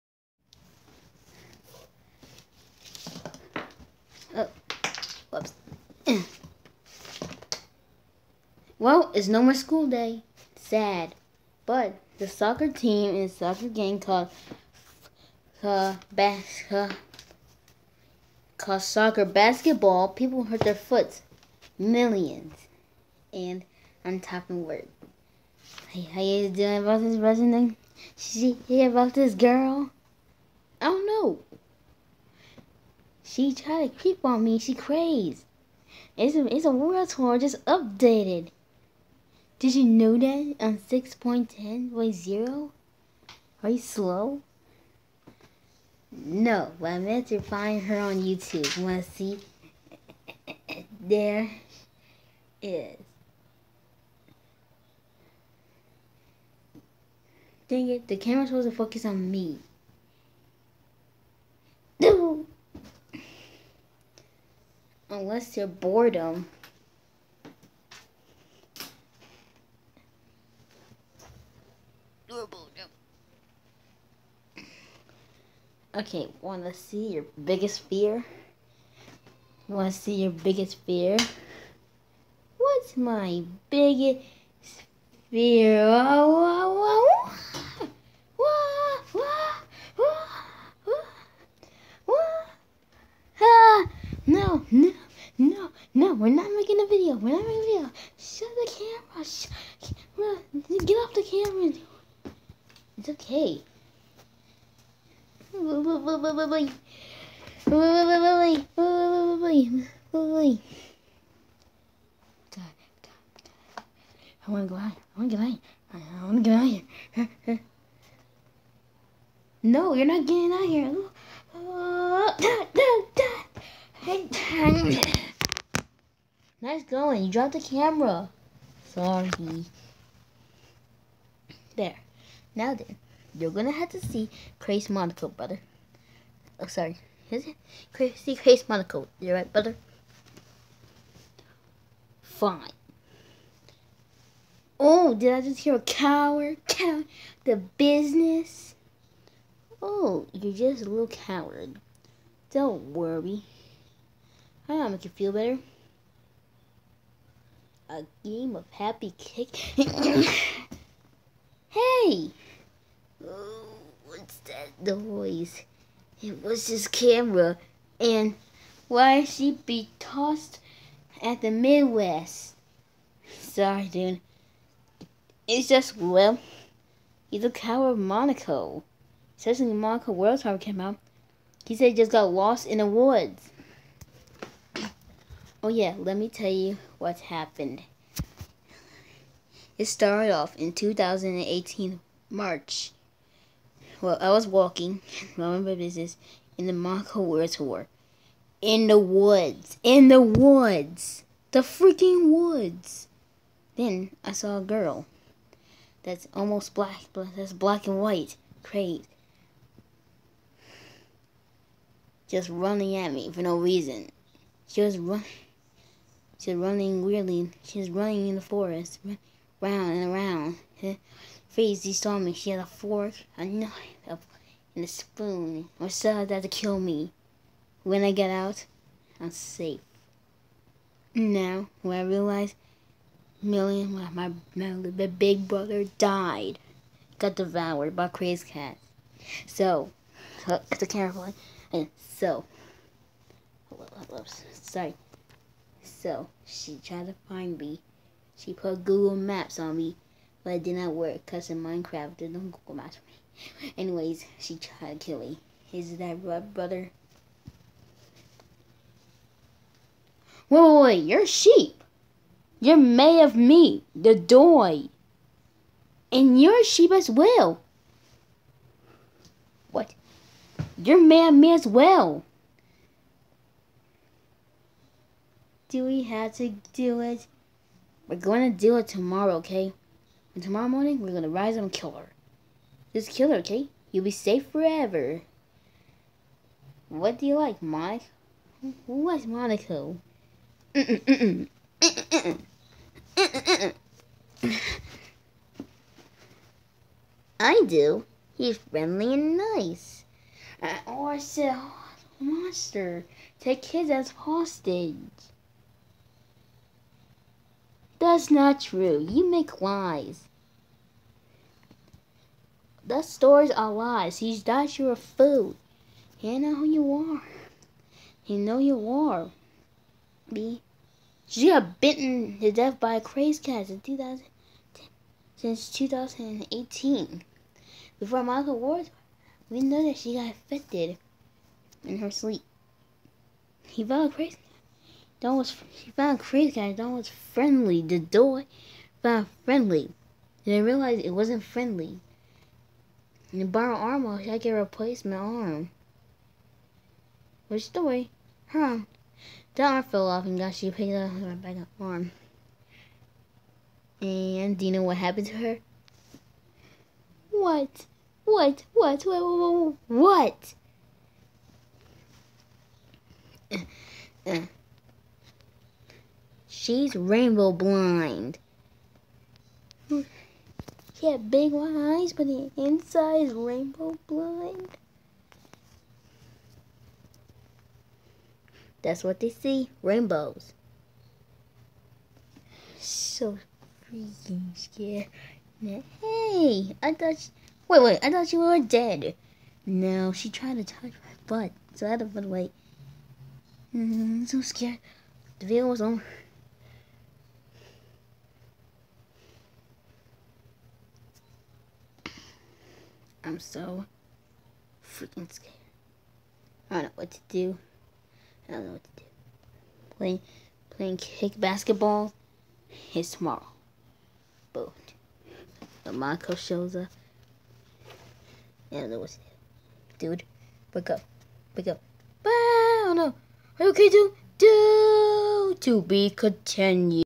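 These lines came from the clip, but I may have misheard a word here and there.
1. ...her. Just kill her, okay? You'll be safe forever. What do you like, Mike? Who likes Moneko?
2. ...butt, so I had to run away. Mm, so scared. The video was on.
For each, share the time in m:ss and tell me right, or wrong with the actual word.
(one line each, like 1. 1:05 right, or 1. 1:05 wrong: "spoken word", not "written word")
1. 4:41 right
2. 6:31 right.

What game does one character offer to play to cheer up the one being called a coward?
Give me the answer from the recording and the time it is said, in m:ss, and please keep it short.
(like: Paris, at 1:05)
happy kick, at 2:38.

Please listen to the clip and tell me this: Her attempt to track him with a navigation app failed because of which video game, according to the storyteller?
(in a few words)
Minecraft.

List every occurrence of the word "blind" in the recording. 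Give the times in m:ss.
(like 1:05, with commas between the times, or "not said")
6:07, 6:14.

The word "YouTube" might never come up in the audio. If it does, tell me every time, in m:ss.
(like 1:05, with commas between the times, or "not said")
0:48.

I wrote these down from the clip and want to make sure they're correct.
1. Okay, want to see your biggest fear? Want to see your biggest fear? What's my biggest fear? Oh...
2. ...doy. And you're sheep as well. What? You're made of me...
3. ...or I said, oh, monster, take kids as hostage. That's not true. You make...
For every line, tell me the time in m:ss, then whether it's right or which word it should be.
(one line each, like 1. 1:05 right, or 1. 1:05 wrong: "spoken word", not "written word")
1. 1:15 right
2. 4:24 right
3. 5:00 right.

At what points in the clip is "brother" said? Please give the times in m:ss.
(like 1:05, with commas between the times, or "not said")
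2:15, 2:19, 3:55, 4:16.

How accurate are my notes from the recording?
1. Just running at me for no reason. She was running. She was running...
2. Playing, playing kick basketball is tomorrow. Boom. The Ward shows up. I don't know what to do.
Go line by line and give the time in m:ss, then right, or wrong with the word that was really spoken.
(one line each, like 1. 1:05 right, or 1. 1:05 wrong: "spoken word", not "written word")
1. 3:32 right
2. 6:49 wrong: "Marco", not "Ward".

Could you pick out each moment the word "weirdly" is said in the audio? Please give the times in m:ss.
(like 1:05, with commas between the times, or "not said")
3:37.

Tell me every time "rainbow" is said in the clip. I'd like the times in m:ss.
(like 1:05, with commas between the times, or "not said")
6:06, 6:13, 6:19.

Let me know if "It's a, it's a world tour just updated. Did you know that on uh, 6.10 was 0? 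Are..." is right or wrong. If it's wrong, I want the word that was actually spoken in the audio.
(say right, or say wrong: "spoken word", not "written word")
right.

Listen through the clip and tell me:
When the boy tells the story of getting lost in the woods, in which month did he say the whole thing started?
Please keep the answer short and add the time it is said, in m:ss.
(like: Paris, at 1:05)
March, at 3:12.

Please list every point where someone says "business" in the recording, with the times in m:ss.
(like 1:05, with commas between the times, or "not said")
2:27, 3:15.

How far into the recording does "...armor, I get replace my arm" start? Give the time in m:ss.
5:43.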